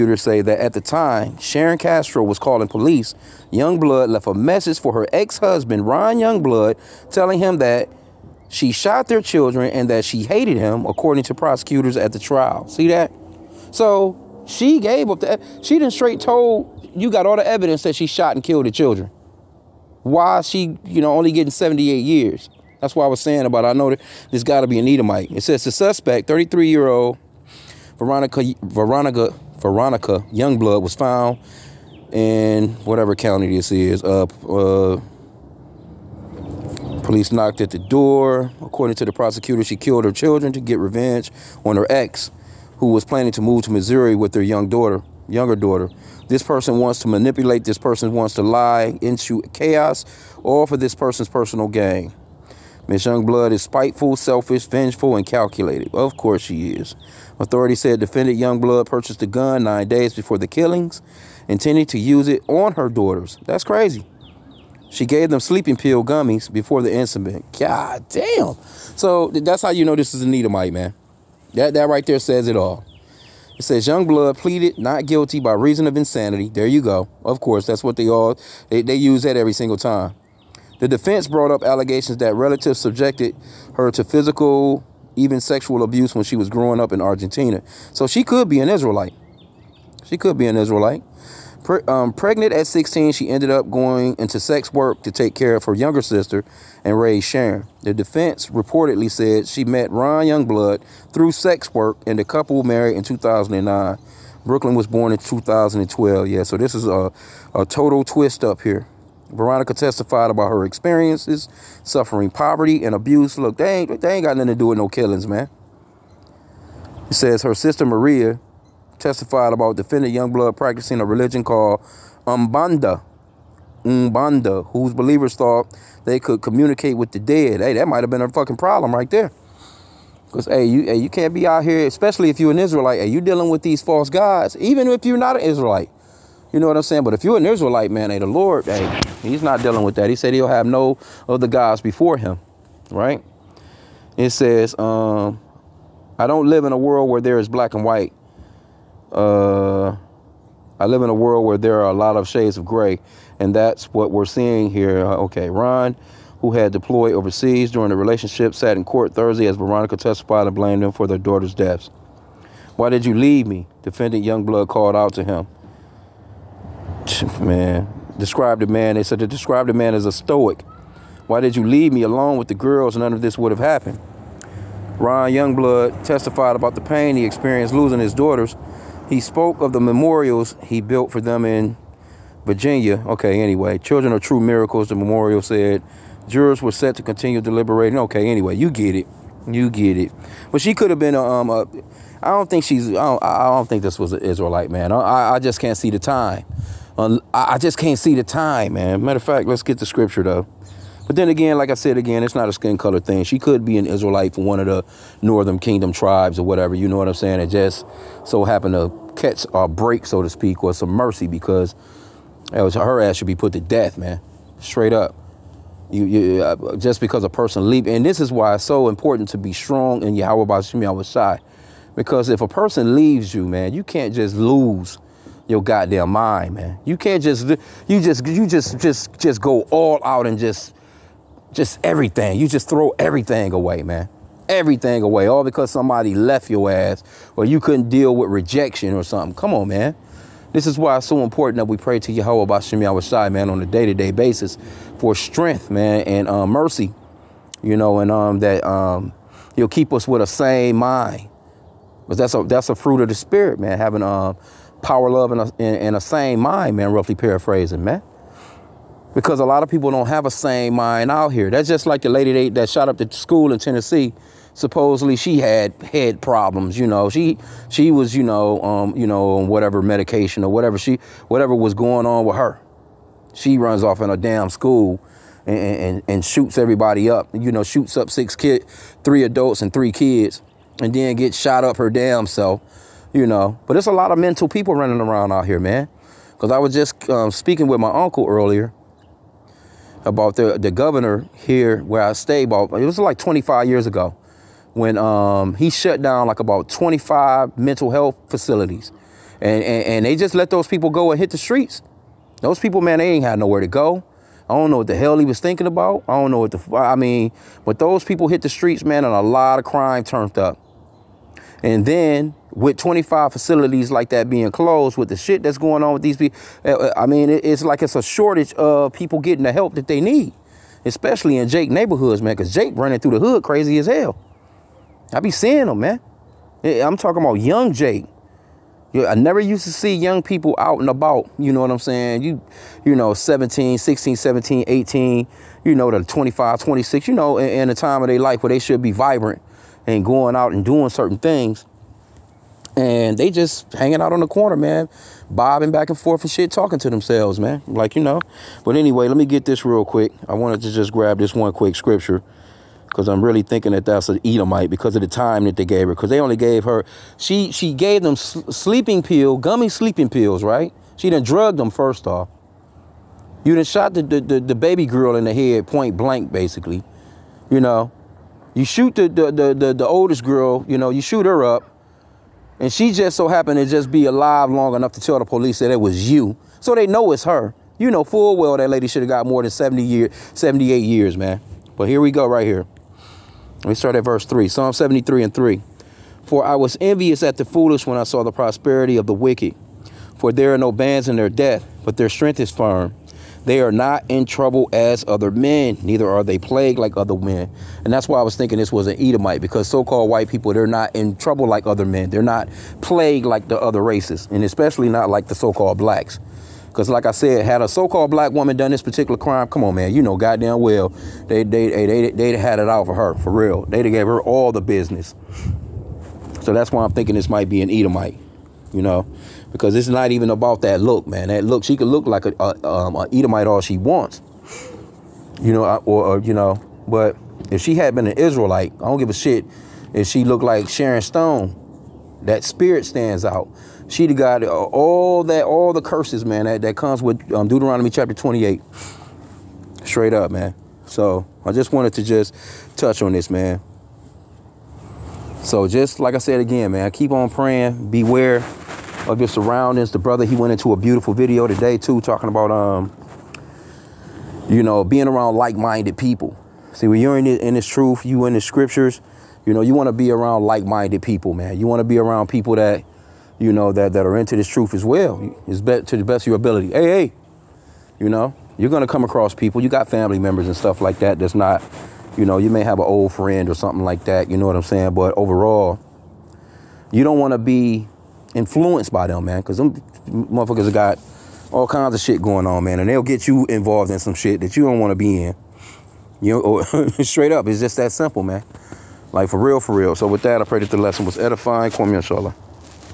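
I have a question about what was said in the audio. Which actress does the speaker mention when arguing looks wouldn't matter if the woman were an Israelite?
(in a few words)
Sharon Stone.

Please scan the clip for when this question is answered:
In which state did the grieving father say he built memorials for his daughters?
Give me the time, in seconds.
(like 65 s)
182 s.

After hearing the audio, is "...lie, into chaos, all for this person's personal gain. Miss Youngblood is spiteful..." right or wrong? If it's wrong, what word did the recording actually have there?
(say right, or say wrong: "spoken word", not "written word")
right.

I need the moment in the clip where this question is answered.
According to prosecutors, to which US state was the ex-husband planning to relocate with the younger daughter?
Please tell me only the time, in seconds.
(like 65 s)
43 s.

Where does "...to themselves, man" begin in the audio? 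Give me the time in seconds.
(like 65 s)
346 s.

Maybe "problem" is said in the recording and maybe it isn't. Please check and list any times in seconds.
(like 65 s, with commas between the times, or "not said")
128 s, 266 s.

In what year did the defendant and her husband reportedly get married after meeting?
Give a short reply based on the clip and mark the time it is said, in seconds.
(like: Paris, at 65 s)
2009, at 103 s.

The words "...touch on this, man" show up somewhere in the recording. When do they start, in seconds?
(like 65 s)
442 s.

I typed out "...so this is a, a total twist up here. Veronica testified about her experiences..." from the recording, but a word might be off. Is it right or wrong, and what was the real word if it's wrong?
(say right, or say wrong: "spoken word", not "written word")
right.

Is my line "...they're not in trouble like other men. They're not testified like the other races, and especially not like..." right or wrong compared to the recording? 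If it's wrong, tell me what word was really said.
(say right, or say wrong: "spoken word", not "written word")
wrong: "plagued", not "testified".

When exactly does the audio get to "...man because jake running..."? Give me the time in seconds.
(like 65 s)
322 s.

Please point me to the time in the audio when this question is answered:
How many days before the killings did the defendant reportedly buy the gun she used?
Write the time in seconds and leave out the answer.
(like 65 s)
59 s.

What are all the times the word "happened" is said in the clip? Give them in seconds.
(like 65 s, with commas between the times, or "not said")
173 s, 208 s, 373 s.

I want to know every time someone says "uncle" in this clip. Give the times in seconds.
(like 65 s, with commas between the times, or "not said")
287 s.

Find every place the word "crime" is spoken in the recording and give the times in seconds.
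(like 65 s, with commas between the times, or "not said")
309 s, 409 s.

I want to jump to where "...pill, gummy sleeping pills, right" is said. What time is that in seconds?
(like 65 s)
359 s.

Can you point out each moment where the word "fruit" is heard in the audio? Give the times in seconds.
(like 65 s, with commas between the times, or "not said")
252 s.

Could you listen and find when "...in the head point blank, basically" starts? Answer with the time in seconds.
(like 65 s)
365 s.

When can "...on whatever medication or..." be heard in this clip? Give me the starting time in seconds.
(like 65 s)
269 s.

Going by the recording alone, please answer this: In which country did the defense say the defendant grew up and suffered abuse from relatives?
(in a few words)
Argentina.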